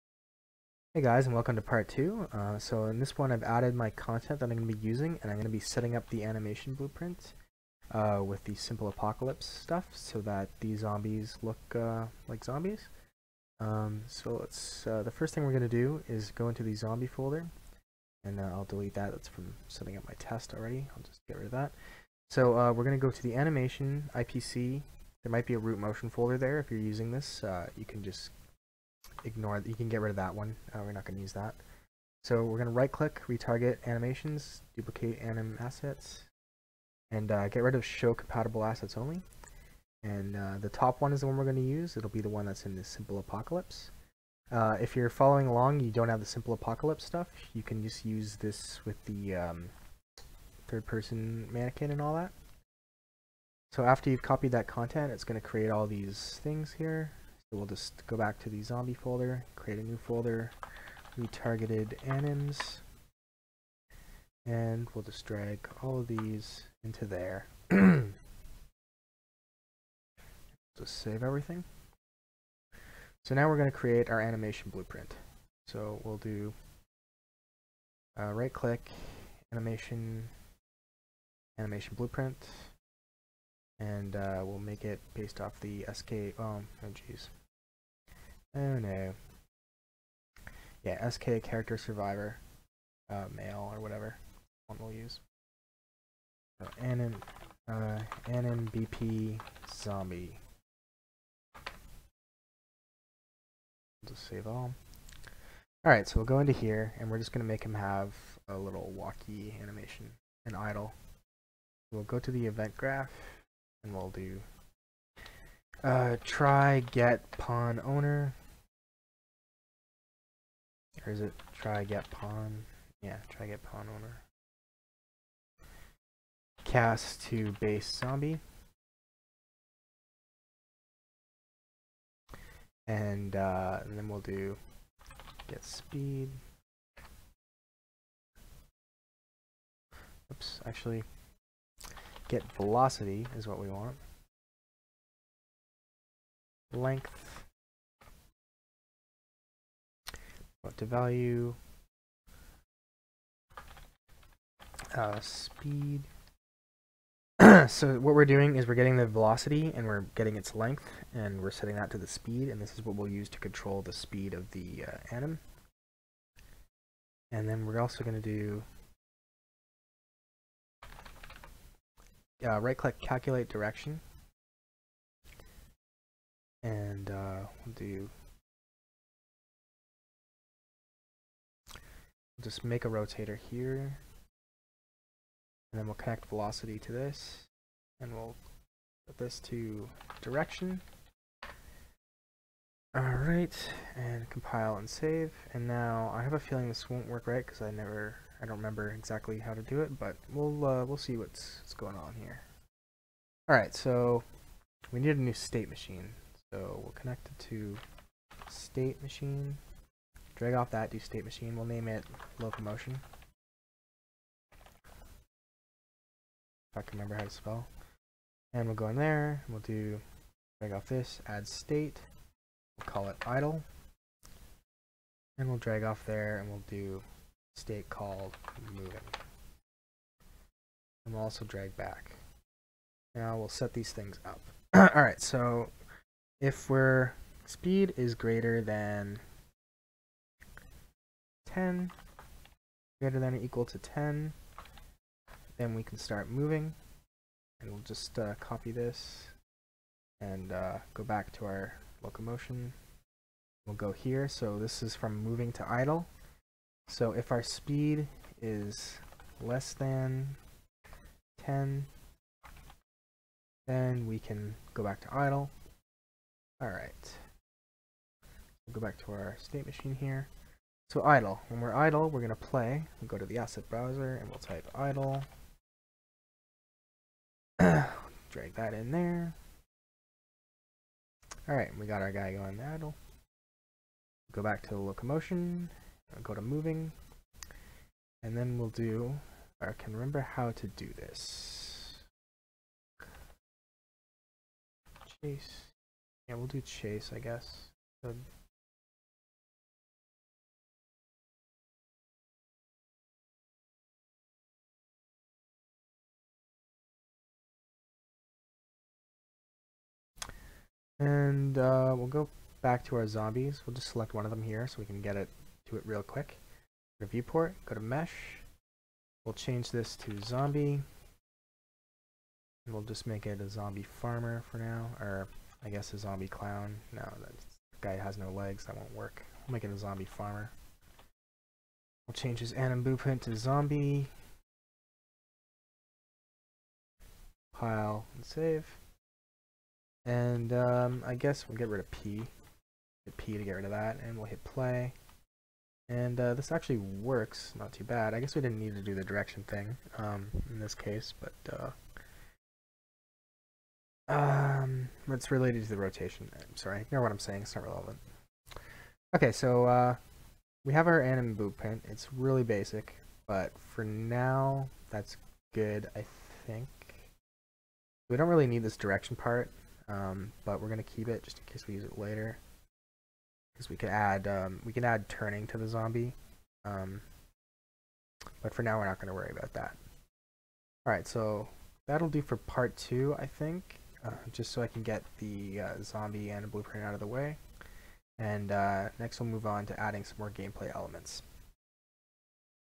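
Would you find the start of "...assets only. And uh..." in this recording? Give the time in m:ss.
0:38.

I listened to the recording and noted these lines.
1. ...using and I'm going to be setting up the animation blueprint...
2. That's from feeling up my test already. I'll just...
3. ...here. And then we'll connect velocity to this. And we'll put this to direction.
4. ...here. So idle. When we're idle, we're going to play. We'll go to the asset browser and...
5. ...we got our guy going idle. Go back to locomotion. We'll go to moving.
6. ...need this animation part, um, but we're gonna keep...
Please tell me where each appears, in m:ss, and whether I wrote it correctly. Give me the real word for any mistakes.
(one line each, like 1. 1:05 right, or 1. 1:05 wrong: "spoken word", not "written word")
1. 0:04 right
2. 0:19 wrong: "setting", not "feeling"
3. 3:03 right
4. 4:29 right
5. 4:41 right
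6. 6:08 wrong: "direction", not "animation".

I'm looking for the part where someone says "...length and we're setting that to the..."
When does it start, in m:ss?
2:40.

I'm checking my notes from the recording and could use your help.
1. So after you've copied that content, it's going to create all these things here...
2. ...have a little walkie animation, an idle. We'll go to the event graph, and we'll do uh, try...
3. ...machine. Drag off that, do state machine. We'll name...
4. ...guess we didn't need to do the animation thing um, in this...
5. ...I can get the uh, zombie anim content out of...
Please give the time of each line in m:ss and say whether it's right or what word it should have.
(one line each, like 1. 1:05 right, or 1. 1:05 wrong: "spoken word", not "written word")
1. 0:53 right
2. 1:47 right
3. 3:29 right
4. 5:48 wrong: "direction", not "animation"
5. 6:24 wrong: "blueprint", not "content".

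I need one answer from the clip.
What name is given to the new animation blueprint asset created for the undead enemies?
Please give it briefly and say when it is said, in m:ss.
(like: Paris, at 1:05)
AnimBP zombie, at 1:38.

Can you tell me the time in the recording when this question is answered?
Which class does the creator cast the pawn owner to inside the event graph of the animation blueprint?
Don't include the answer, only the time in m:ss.
2:07.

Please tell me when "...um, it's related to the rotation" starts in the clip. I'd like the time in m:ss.
5:54.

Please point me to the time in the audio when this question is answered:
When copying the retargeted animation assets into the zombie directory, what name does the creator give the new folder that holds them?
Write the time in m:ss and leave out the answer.
1:01.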